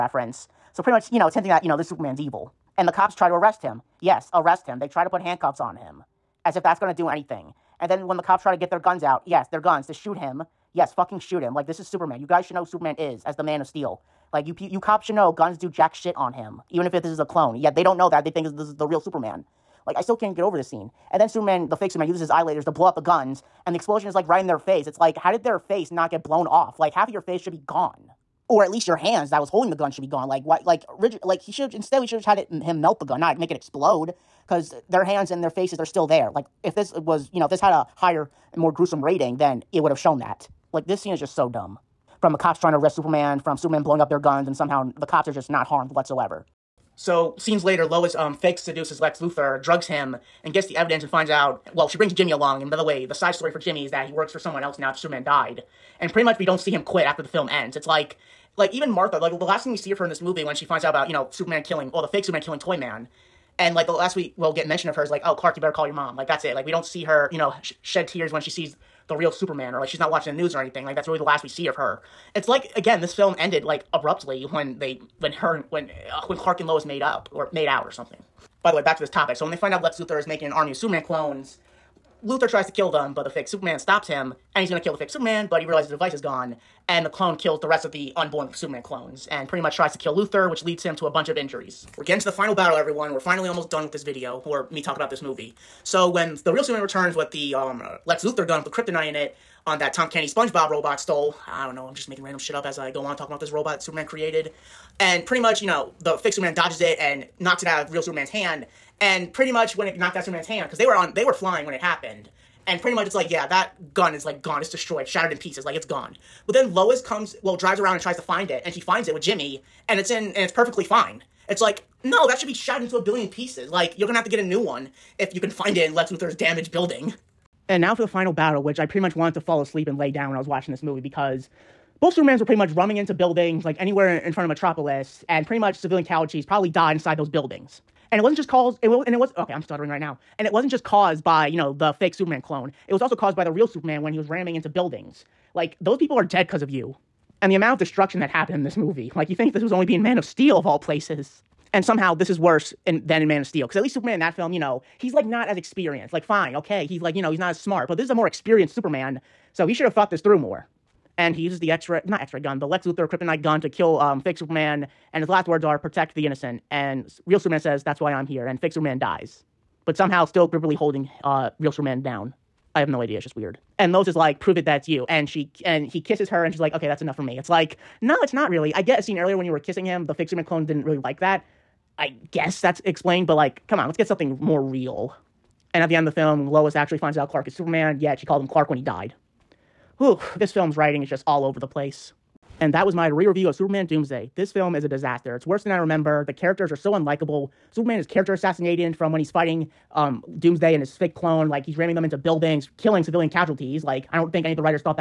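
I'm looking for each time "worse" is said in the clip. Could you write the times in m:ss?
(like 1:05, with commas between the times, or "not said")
2:32, 3:15.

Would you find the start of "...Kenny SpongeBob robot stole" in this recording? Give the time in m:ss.
1:40.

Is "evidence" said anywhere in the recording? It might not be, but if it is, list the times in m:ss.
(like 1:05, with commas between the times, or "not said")
0:50.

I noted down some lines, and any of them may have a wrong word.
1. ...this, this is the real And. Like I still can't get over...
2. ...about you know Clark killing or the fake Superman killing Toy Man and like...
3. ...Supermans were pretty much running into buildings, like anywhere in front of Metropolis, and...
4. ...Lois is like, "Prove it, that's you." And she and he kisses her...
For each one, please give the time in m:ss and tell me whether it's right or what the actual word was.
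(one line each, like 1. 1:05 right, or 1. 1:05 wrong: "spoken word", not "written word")
1. 0:18 wrong: "Superman", not "And"
2. 1:00 wrong: "Superman", not "Clark"
3. 2:12 right
4. 2:53 right.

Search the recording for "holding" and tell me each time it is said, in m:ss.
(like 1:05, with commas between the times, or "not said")
0:29, 2:50.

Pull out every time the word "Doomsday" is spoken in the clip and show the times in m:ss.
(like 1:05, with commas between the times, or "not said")
3:13, 3:20.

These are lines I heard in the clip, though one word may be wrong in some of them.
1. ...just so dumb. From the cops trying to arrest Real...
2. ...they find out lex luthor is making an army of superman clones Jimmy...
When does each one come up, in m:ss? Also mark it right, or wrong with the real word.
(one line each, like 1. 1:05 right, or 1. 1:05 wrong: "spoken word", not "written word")
1. 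0:41 wrong: "Superman", not "Real"
2. 1:19 wrong: "Luthor", not "Jimmy".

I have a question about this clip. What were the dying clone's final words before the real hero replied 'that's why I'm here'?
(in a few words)
Protect the innocent.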